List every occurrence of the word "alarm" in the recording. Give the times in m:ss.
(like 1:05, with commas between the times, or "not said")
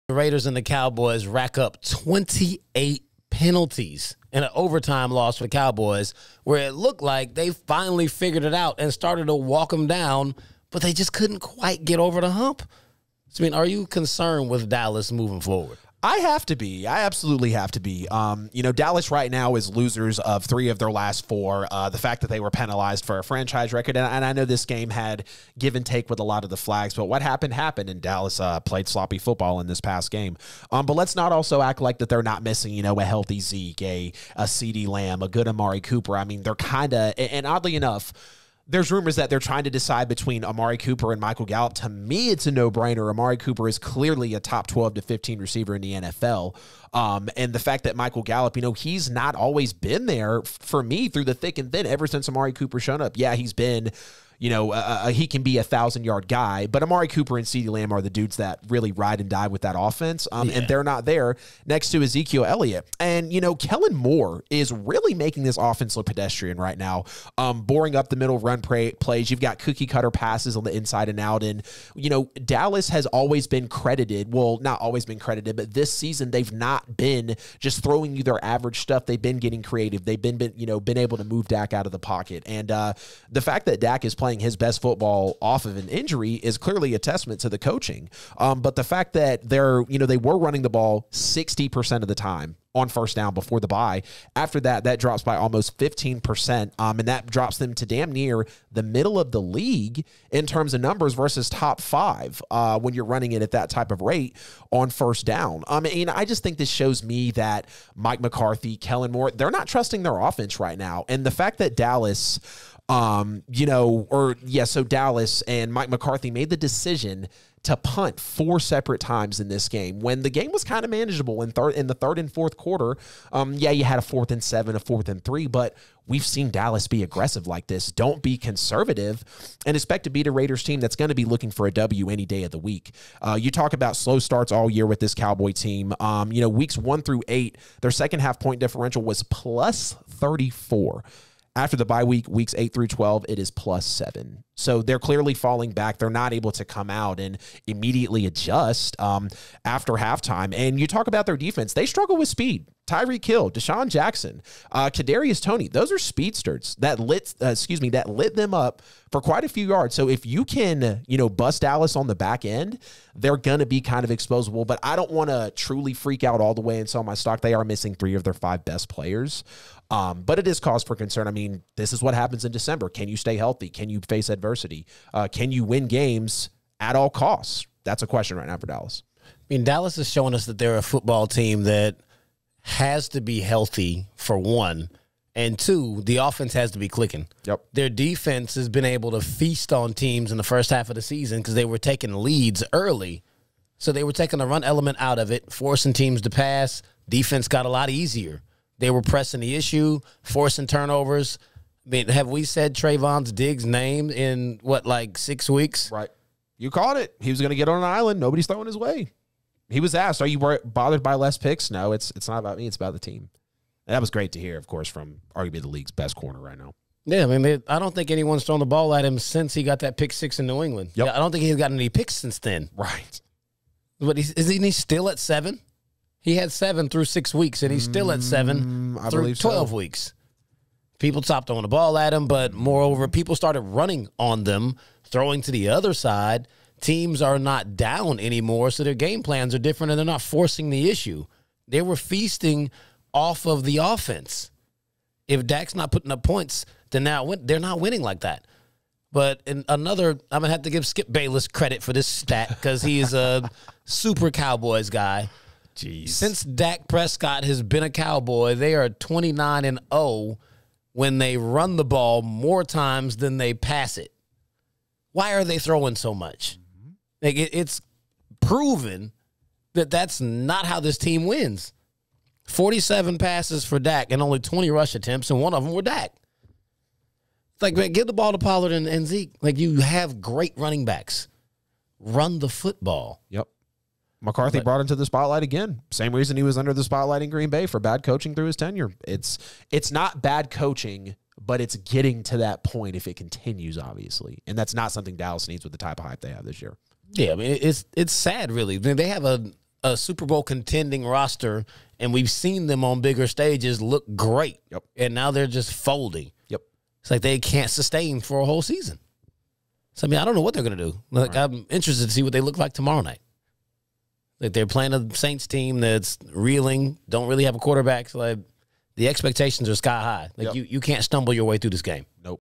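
not said.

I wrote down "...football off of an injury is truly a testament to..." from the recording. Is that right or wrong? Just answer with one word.
wrong.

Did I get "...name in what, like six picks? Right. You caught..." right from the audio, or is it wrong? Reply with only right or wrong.
wrong.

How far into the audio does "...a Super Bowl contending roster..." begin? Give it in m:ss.
4:59.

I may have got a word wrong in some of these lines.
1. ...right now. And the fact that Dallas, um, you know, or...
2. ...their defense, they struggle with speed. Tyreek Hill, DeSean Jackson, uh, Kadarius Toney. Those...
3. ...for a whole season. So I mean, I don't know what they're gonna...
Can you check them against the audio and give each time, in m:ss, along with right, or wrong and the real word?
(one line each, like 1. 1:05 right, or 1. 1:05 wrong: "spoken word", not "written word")
1. 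1:50 right
2. 2:31 right
3. 5:08 right.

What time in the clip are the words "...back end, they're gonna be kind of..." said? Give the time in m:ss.
2:42.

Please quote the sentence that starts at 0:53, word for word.
Yeah, he's been you know, uh, uh, he can be a thousand yard guy.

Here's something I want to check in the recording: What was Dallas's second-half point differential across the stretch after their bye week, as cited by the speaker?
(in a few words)
+7.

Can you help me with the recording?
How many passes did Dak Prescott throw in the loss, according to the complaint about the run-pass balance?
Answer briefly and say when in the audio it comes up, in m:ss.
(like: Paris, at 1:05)
47, at 4:32.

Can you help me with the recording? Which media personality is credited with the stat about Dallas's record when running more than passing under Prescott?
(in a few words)
Skip Bayless.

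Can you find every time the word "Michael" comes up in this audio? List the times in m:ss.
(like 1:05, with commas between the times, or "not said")
0:41, 0:47.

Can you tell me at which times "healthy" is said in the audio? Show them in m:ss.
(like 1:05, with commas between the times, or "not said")
0:33, 2:53, 3:03.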